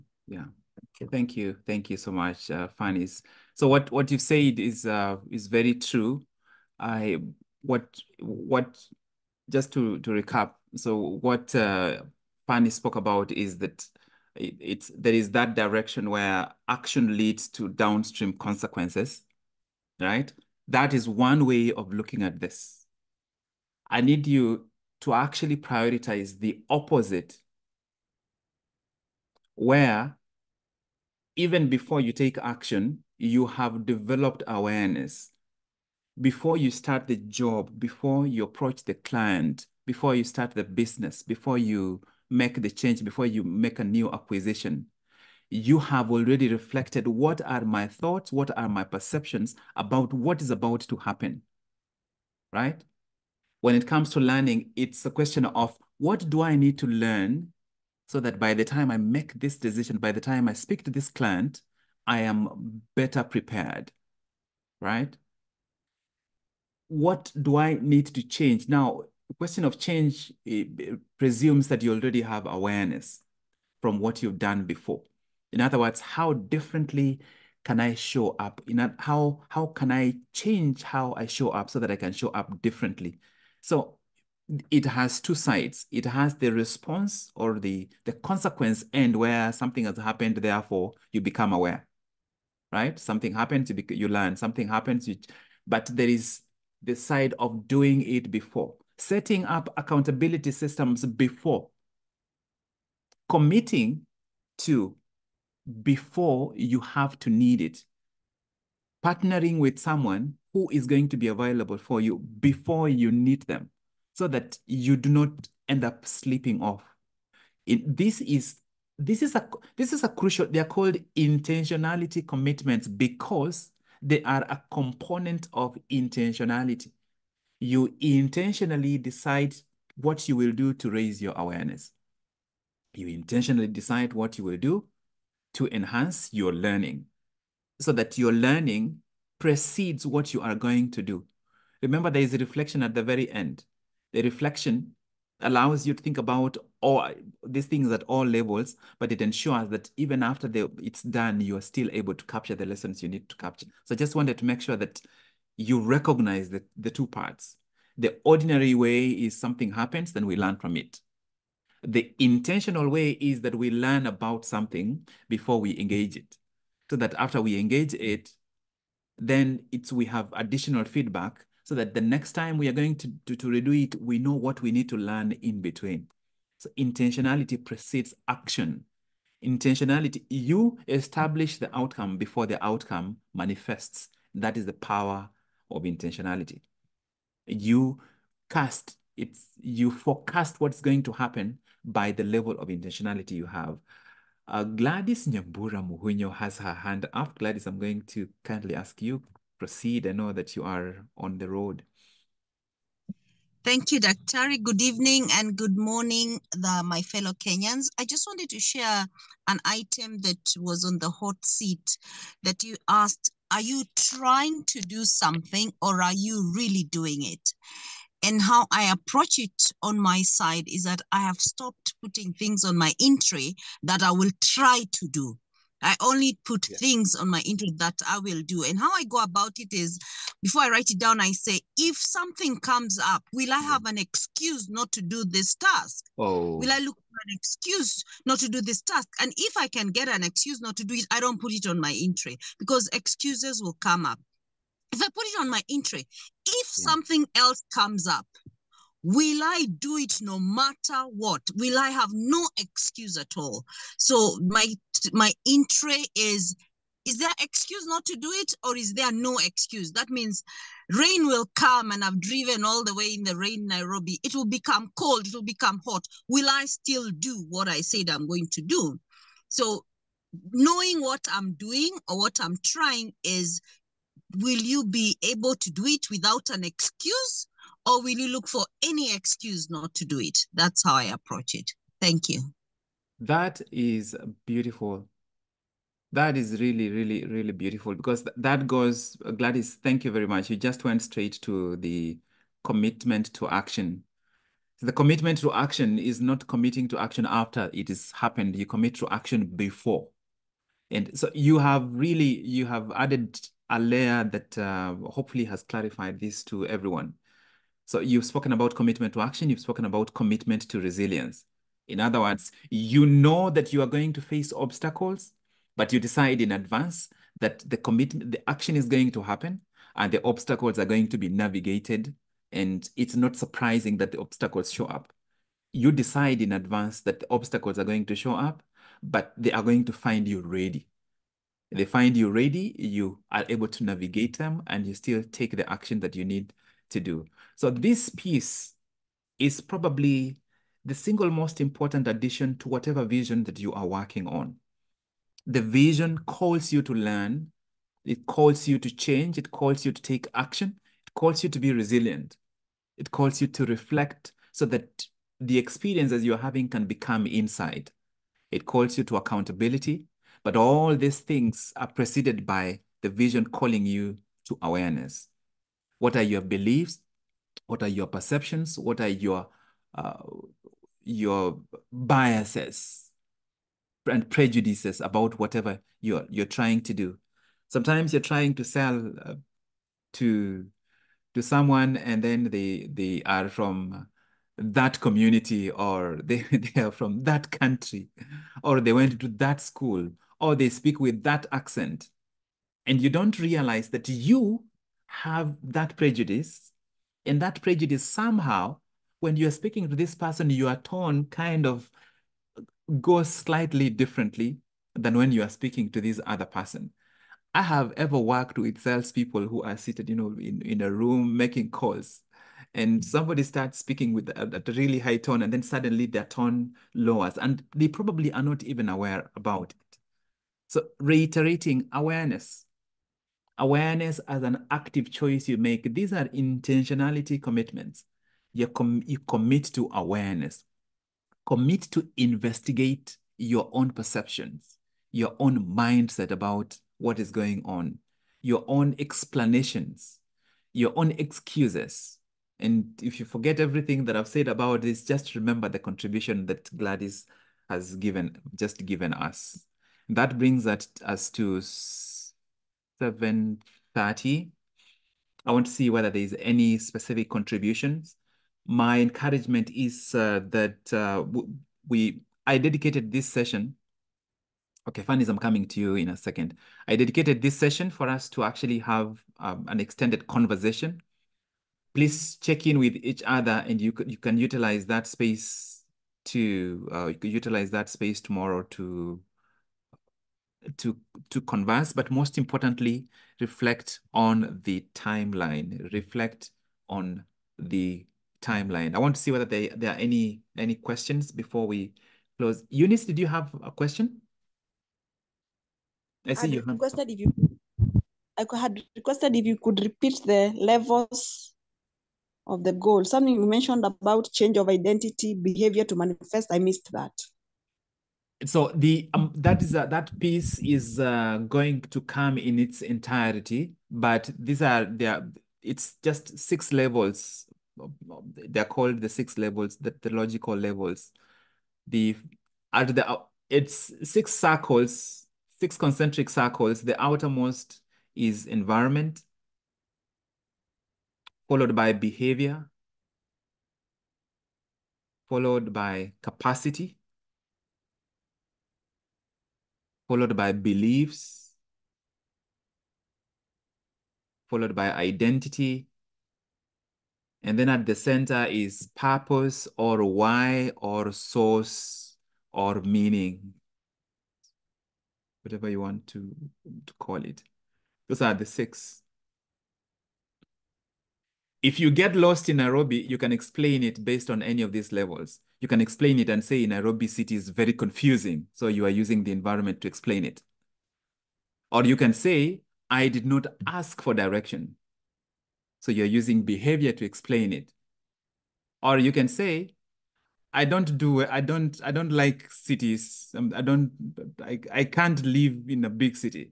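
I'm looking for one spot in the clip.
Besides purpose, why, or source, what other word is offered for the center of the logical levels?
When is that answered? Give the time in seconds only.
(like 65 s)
552 s.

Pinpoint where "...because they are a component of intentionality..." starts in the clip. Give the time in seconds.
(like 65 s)
122 s.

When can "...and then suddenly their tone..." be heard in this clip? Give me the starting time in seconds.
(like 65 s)
415 s.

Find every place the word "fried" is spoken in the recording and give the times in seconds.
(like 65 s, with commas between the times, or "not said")
not said.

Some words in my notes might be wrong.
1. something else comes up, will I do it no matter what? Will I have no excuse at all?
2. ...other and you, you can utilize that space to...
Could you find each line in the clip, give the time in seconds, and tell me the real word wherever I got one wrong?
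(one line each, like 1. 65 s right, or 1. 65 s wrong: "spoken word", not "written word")
1. 246 s right
2. 473 s right.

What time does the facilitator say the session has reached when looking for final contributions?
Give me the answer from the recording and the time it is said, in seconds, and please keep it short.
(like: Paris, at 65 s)
7.30, at 453 s.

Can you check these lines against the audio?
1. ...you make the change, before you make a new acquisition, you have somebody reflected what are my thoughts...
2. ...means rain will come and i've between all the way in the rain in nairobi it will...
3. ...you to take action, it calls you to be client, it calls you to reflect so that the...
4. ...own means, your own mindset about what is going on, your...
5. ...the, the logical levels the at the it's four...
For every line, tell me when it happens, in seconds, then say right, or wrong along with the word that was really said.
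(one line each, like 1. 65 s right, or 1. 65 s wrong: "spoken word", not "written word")
1. 41 s wrong: "already", not "somebody"
2. 260 s wrong: "driven", not "between"
3. 349 s wrong: "resilient", not "client"
4. 433 s wrong: "perceptions", not "means"
5. 519 s wrong: "six", not "four".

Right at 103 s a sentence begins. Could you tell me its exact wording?
Committing to before you have to need it.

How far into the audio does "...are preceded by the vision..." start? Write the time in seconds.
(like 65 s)
361 s.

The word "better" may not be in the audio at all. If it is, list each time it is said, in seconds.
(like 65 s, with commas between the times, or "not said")
62 s.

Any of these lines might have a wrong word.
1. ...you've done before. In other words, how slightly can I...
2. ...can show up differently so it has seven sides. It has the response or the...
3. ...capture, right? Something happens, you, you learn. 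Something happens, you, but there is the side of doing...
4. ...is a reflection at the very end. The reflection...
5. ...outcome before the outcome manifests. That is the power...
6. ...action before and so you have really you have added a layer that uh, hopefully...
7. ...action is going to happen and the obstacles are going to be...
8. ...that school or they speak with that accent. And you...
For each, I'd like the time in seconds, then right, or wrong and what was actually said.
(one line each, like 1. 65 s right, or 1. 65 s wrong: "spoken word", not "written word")
1. 74 s wrong: "differently", not "slightly"
2. 81 s wrong: "two", not "seven"
3. 91 s wrong: "aware", not "capture"
4. 142 s right
5. 181 s right
6. 299 s right
7. 318 s right
8. 389 s right.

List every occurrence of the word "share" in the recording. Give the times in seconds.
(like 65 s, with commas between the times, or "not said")
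208 s.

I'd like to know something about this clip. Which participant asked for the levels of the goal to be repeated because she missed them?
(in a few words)
Eunice.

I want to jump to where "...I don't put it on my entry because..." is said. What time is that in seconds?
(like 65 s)
241 s.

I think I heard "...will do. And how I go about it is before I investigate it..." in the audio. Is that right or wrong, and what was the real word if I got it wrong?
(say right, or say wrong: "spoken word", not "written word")
wrong: "write", not "investigate".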